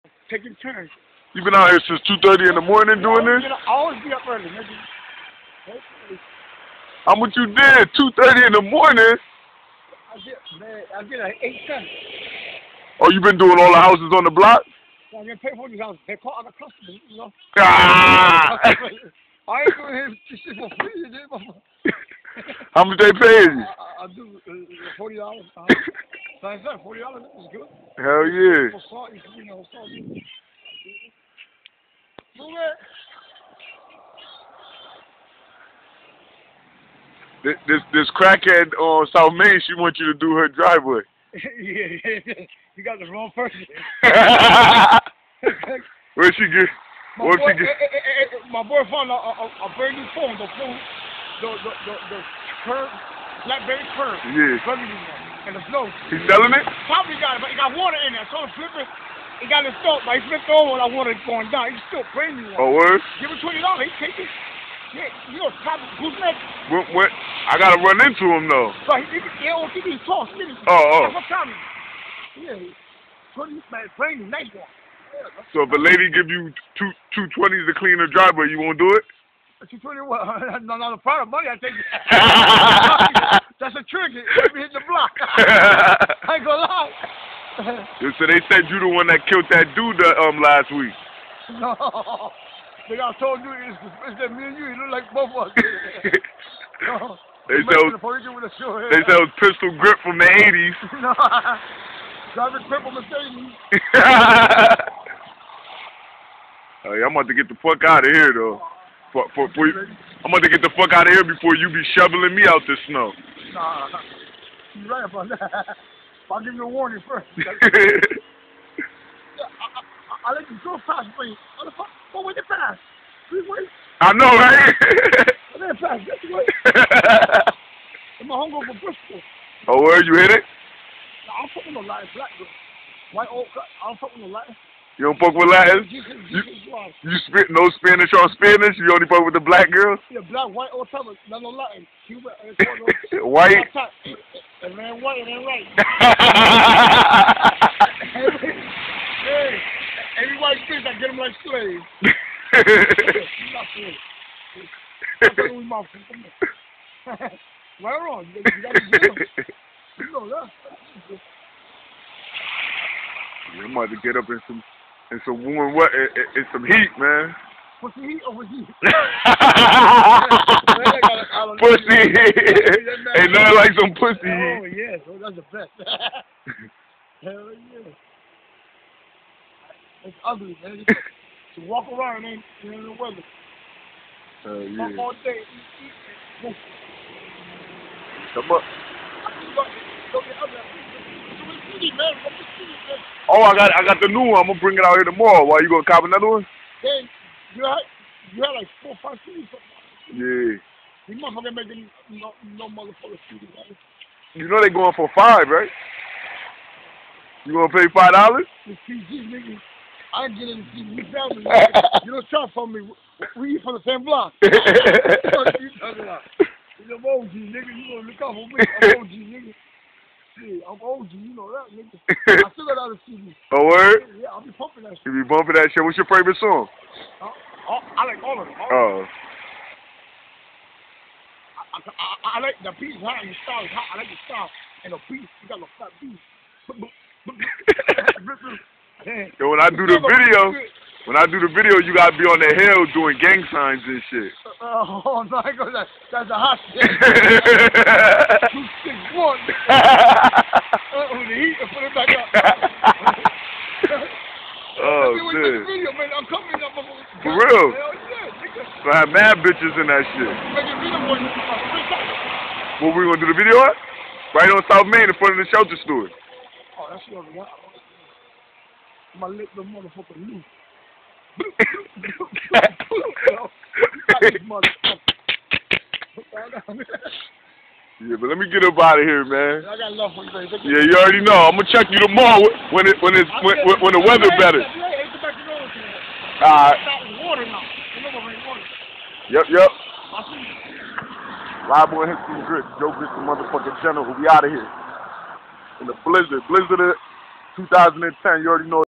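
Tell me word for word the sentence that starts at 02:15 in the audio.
You, you, you, spit no Spanish on Spanish?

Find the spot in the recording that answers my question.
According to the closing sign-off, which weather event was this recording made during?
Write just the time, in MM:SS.
04:56.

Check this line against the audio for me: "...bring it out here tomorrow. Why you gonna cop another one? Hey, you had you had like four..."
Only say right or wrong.
right.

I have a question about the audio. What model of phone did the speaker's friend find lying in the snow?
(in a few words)
BlackBerry Curve.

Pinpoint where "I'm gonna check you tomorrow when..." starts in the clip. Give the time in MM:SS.
04:41.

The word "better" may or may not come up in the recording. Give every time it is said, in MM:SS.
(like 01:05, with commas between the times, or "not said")
04:44.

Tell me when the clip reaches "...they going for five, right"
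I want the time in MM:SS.
03:24.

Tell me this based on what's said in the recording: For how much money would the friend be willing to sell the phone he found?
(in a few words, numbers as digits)
$20.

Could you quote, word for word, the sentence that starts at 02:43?
I'm about get up in some and some warm what and, and some heat, man.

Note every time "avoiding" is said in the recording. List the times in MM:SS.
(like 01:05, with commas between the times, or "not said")
not said.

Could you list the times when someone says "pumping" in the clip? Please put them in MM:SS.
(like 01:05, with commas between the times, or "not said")
03:44.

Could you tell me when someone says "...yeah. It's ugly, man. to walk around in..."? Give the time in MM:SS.
02:57.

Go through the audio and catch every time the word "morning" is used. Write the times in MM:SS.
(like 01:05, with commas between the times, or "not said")
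00:02, 00:08.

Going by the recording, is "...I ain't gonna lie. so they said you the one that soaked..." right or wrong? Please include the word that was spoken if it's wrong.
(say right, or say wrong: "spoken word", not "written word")
wrong: "killed", not "soaked".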